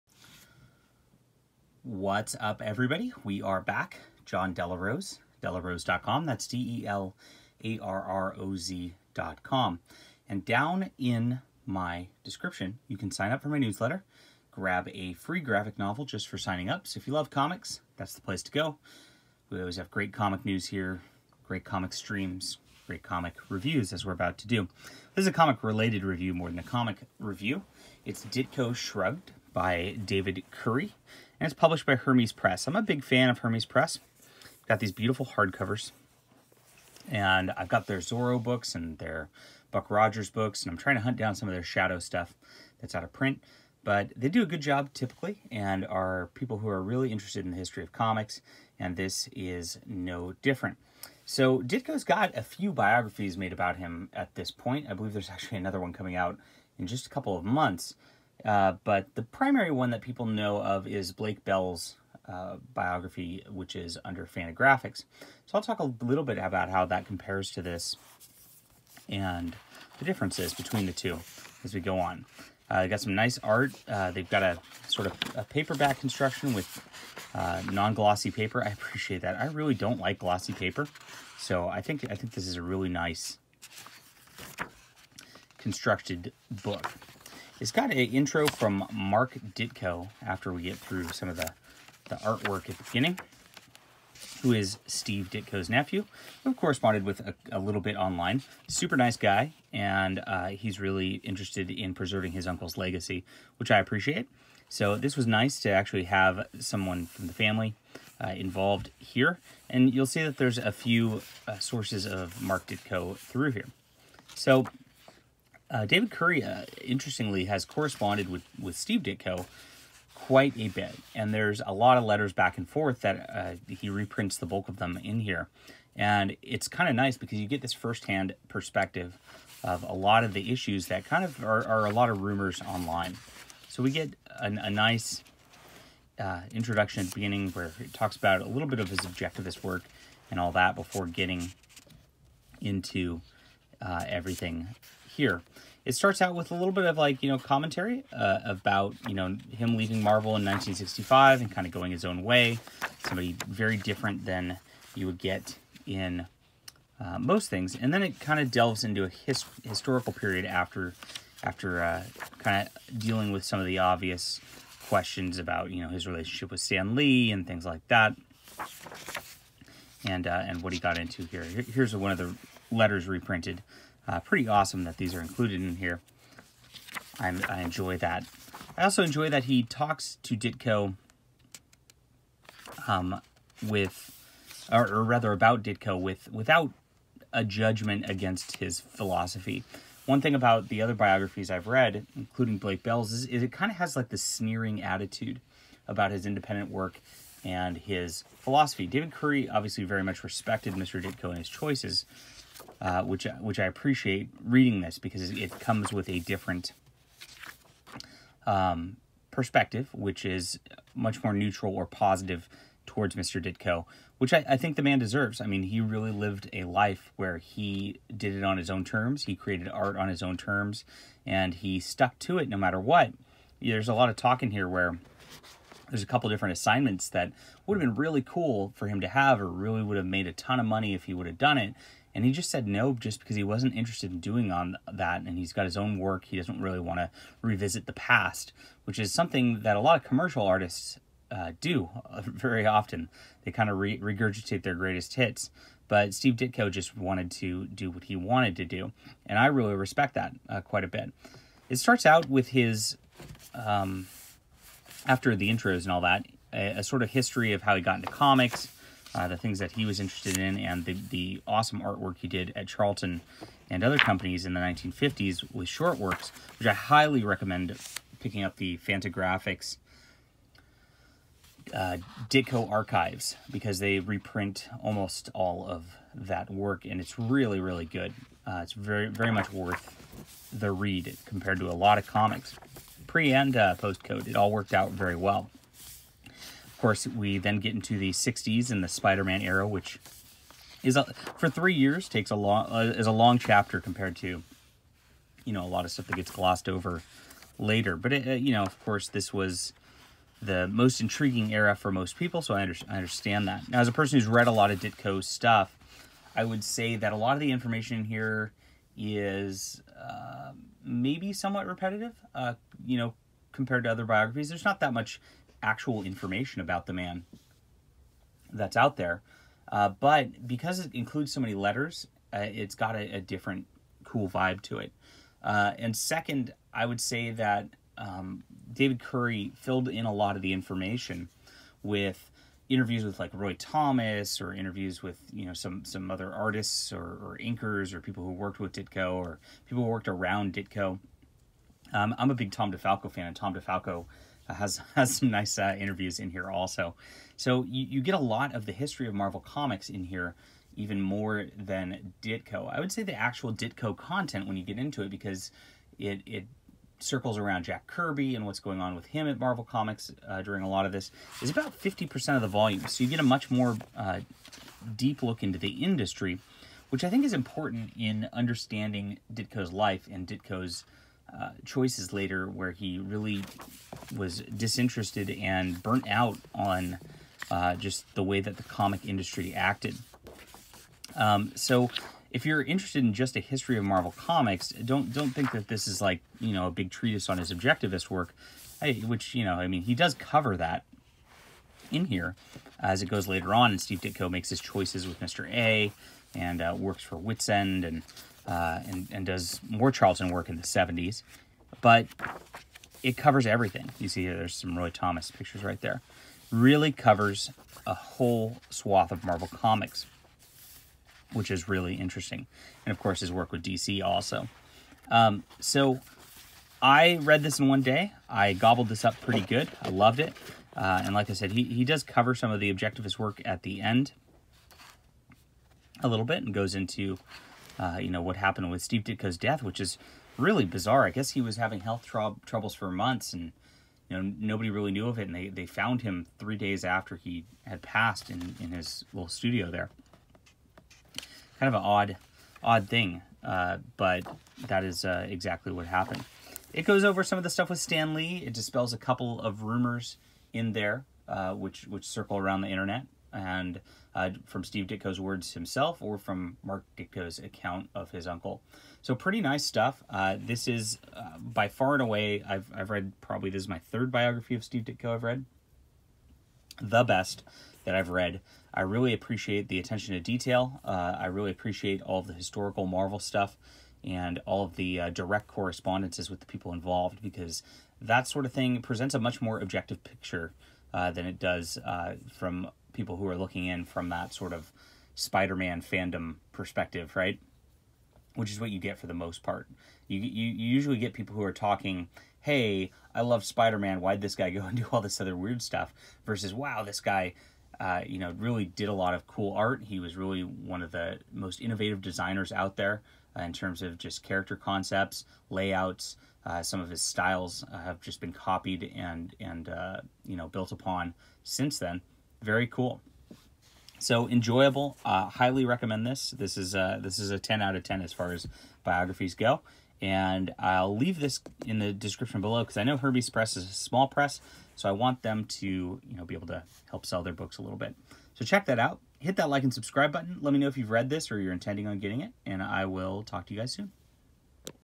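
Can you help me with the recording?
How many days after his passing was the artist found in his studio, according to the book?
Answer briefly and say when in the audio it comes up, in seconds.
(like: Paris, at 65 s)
3, at 436 s.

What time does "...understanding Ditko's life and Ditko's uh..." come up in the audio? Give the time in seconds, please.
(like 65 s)
368 s.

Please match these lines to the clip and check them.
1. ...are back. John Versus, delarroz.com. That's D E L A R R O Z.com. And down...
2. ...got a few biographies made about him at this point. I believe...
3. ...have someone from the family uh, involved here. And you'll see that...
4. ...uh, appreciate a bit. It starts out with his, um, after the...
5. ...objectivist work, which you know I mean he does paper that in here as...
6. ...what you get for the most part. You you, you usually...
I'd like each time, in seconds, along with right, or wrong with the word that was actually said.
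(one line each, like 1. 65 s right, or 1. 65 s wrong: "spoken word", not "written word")
1. 3 s wrong: "Delarose", not "Versus"
2. 52 s right
3. 106 s right
4. 250 s wrong: "quite", not "appreciate"
5. 387 s wrong: "cover", not "paper"
6. 488 s right.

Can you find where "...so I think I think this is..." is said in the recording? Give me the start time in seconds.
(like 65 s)
81 s.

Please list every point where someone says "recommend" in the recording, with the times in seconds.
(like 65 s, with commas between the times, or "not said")
267 s, 515 s.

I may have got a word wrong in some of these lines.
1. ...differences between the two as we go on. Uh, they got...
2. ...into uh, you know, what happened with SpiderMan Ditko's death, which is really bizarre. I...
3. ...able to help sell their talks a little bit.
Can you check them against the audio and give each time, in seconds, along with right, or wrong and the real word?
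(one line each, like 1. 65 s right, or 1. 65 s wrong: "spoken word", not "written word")
1. 70 s right
2. 426 s wrong: "Steve", not "SpiderMan"
3. 526 s wrong: "books", not "talks".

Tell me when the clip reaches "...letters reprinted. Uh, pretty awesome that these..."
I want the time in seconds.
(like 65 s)
172 s.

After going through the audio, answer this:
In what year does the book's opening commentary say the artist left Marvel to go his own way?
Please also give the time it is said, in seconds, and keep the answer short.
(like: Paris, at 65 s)
1965, at 150 s.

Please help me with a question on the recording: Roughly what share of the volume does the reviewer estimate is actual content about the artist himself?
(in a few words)
50%.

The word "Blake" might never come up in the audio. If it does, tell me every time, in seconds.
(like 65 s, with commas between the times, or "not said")
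61 s, 192 s.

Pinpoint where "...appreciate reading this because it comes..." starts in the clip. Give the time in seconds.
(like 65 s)
203 s.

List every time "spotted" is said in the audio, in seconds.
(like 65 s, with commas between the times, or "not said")
not said.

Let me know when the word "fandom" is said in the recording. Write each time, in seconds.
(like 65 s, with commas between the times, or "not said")
485 s.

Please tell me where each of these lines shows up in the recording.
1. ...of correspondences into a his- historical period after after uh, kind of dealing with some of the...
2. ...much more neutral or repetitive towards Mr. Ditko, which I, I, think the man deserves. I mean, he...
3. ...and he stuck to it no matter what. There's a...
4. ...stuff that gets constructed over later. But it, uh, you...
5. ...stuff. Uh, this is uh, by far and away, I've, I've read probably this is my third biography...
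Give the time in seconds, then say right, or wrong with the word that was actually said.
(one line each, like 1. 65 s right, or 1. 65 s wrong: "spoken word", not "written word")
1. 158 s wrong: "delves", not "correspondences"
2. 210 s wrong: "positive", not "repetitive"
3. 221 s right
4. 295 s wrong: "glossed", not "constructed"
5. 459 s right.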